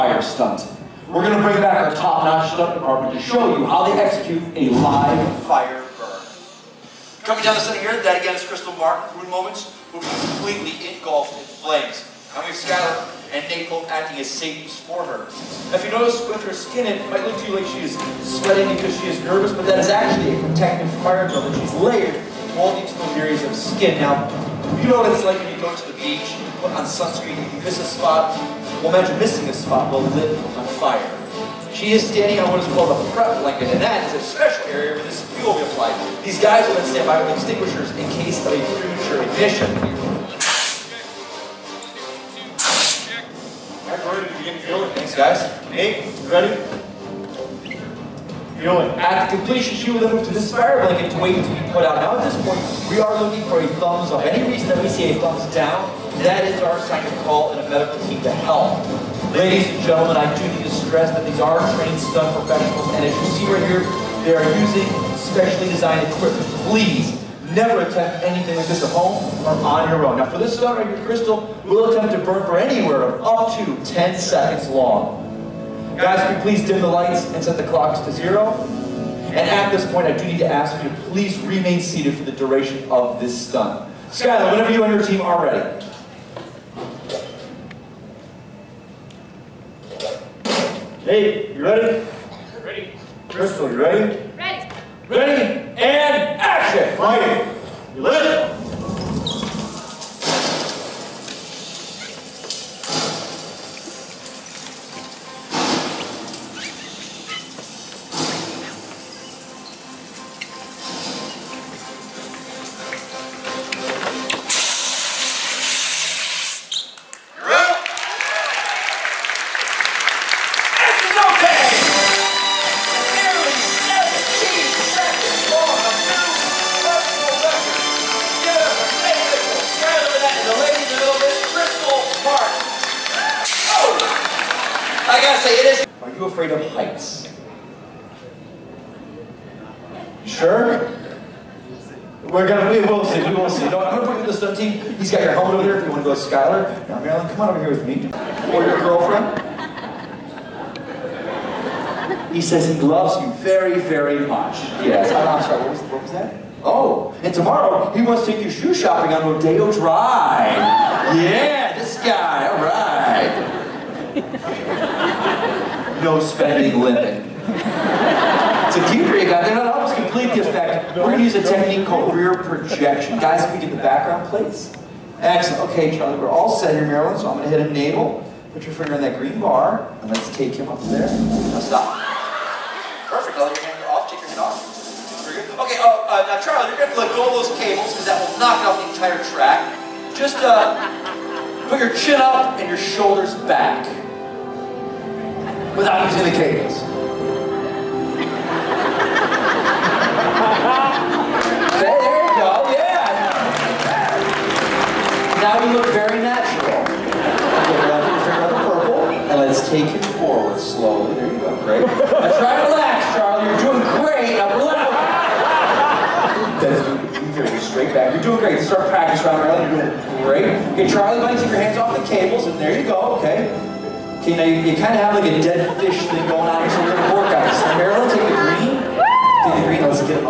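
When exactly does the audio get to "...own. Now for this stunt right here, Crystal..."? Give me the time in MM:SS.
01:10.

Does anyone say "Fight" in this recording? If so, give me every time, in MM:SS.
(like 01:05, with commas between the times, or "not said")
01:36.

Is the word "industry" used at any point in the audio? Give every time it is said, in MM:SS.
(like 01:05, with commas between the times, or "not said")
not said.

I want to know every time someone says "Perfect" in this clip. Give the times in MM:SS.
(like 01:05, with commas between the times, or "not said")
03:03.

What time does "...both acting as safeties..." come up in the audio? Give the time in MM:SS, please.
00:13.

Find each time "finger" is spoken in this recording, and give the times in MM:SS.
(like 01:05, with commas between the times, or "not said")
02:58, 03:28.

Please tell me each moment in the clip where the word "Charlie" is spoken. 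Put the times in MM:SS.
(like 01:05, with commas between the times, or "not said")
02:55, 03:06, 03:33, 03:40.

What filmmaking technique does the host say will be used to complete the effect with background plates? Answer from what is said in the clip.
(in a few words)
rear projection.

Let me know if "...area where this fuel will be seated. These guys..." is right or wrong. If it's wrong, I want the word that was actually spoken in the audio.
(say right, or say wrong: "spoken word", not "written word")
wrong: "applied", not "seated".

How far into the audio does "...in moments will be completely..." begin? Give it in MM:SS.
00:09.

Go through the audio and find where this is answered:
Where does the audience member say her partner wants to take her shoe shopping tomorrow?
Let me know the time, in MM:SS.
02:39.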